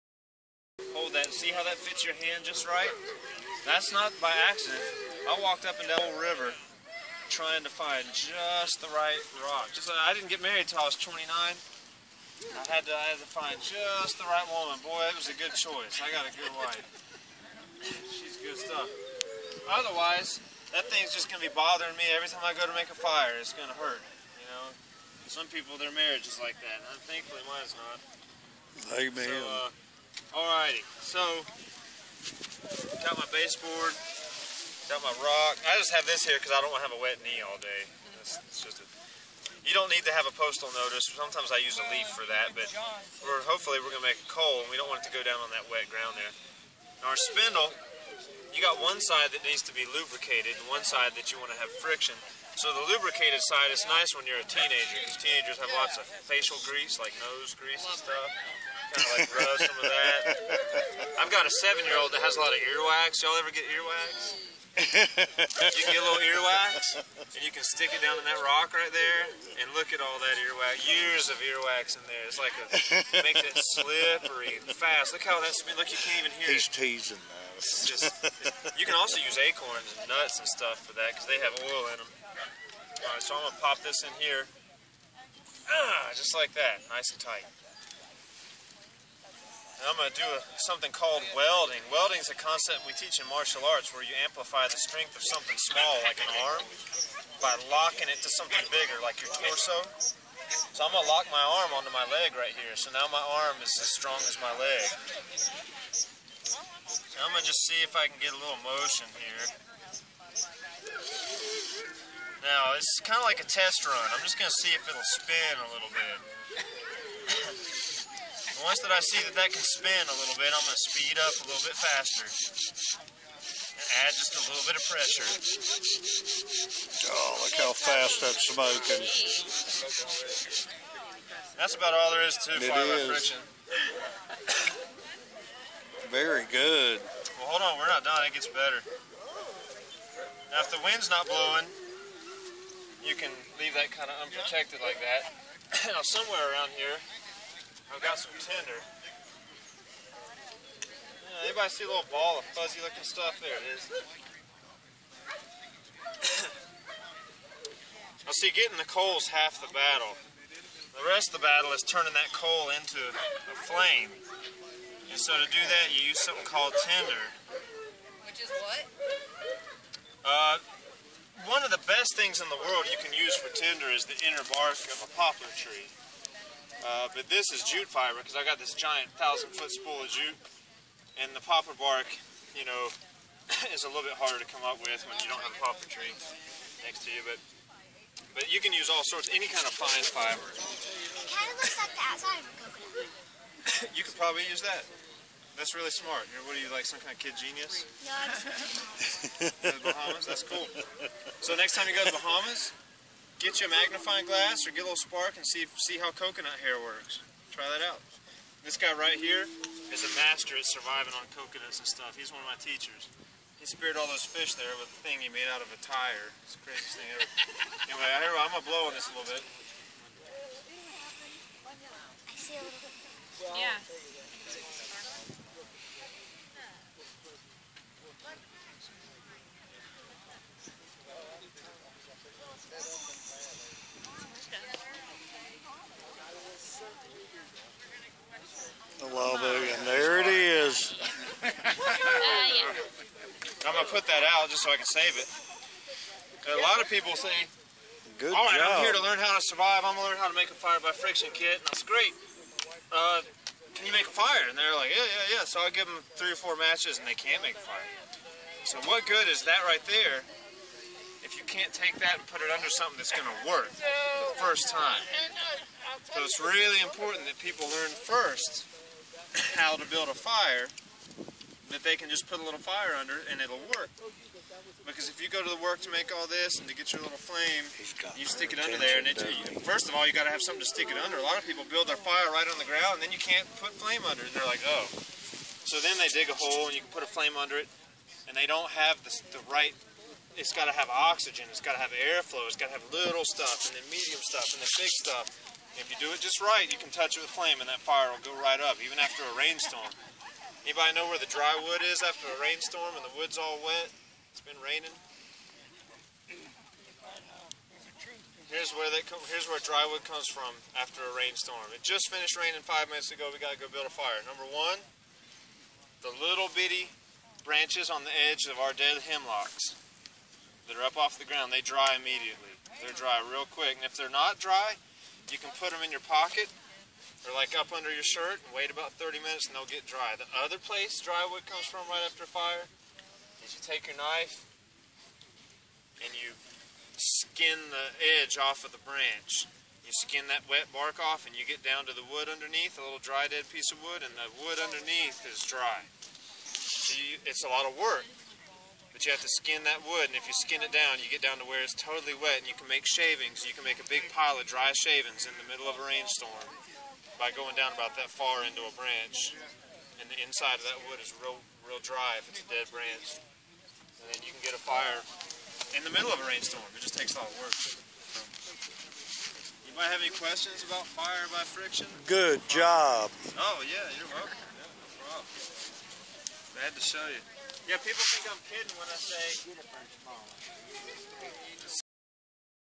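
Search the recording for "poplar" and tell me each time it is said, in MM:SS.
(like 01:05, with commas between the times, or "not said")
02:55, 03:01, 03:05.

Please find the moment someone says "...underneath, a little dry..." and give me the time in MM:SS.
05:42.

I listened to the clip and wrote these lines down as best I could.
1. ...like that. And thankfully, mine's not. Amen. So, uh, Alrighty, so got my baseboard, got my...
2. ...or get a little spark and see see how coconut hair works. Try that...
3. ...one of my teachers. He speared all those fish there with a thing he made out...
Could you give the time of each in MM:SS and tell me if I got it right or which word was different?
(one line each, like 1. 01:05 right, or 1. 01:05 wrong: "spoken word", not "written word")
1. 00:26 right
2. 03:24 right
3. 03:32 right.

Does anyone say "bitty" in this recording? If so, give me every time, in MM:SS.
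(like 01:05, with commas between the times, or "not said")
05:16.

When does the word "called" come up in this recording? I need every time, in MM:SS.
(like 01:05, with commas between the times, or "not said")
01:30, 02:46.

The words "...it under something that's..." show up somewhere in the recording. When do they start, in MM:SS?
04:22.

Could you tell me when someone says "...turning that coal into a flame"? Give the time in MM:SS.
02:41.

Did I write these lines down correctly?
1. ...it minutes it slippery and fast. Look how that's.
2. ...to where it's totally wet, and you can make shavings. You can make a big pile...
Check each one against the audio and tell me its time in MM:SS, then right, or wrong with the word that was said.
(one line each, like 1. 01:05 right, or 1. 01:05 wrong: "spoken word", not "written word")
1. 01:13 wrong: "makes", not "minutes"
2. 05:51 right.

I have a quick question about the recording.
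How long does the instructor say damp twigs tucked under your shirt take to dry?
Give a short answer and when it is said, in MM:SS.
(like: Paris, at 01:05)
30 minutes, at 05:28.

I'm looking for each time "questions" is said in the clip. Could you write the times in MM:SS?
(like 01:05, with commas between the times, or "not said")
06:10.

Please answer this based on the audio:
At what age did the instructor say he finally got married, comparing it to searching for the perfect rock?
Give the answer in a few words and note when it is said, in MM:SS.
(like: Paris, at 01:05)
29, at 00:11.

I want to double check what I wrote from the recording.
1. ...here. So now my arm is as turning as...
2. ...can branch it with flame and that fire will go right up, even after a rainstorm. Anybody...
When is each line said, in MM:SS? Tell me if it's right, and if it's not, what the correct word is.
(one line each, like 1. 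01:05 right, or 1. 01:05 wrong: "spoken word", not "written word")
1. 01:42 wrong: "strong", not "turning"
2. 04:56 wrong: "touch", not "branch".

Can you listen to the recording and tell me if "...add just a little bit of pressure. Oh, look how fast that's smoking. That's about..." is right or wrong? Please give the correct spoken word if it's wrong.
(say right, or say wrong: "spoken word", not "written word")
right.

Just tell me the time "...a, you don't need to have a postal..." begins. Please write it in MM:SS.
00:38.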